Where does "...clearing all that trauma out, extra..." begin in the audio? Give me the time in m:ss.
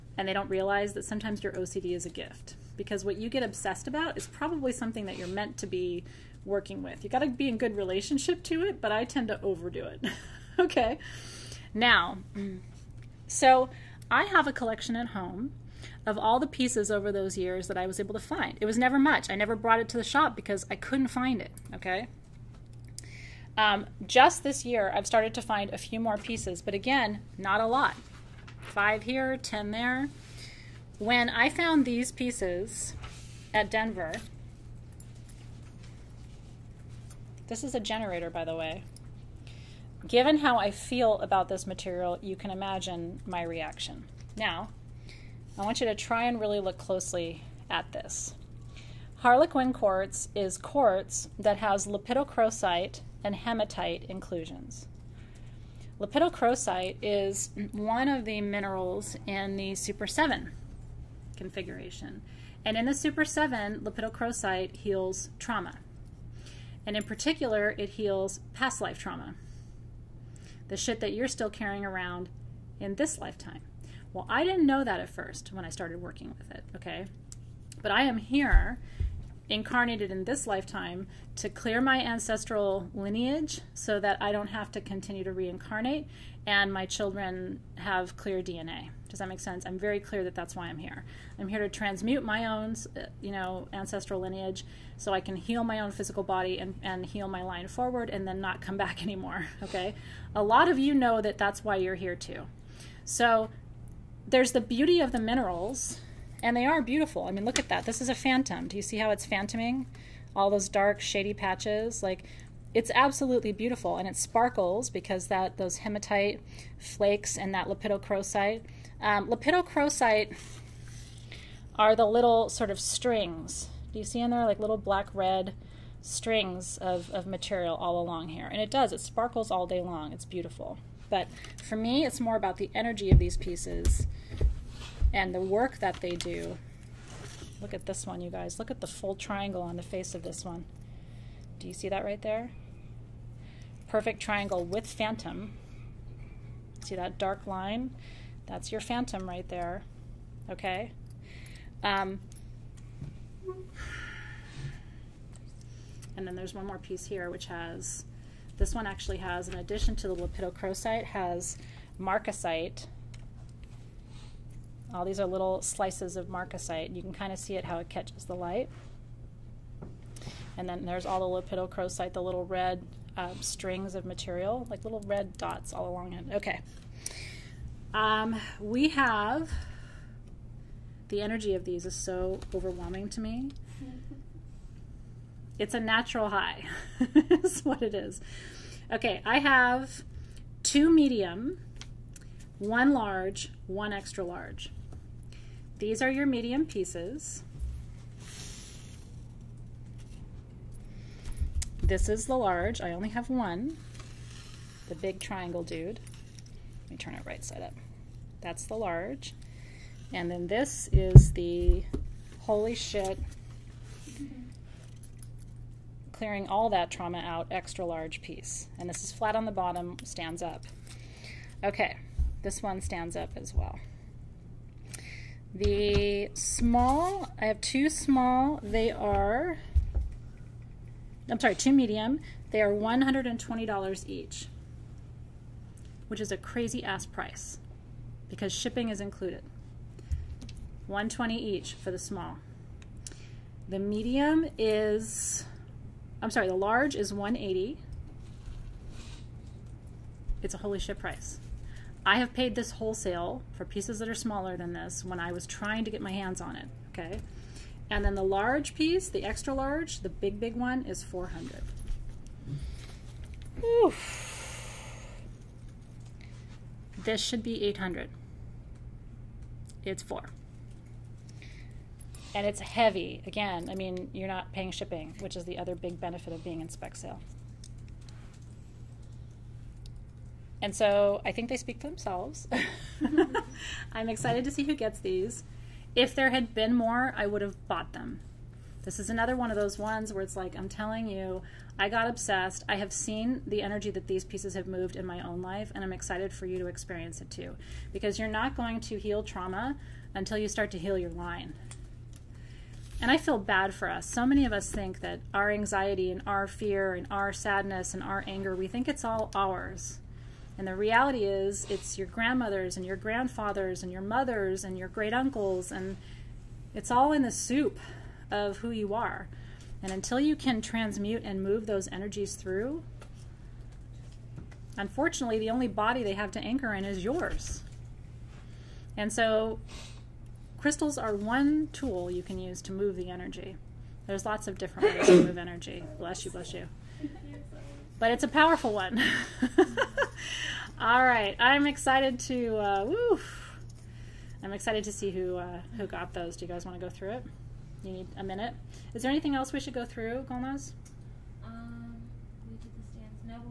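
3:36.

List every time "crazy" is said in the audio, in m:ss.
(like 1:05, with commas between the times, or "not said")
3:56.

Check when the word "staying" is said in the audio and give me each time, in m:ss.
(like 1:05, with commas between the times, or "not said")
not said.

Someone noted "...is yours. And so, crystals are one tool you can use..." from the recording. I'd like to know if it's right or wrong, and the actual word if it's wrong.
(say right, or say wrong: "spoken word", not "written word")
right.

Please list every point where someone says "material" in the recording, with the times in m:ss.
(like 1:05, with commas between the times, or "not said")
0:41, 2:07, 2:54.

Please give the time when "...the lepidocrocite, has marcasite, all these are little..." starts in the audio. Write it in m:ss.
2:40.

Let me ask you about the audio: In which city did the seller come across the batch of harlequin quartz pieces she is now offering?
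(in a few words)
Denver.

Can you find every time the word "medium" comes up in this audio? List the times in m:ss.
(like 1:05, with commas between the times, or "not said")
3:10, 3:16, 3:51, 4:03.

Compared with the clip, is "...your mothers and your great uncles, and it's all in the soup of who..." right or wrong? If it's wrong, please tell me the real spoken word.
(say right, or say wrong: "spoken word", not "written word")
right.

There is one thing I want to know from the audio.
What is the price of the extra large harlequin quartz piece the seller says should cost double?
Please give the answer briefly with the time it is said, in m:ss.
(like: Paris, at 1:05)
$400, at 4:21.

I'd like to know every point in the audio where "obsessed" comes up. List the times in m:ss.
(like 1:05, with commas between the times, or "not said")
0:03, 4:52.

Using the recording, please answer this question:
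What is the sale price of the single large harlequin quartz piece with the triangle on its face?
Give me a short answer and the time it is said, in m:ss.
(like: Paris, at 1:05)
$180, at 4:07.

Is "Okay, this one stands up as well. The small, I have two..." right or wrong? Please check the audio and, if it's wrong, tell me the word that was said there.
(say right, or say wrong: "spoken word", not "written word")
right.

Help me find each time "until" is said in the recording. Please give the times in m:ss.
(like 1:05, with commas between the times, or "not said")
5:00, 5:19.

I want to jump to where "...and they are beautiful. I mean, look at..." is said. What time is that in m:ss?
1:46.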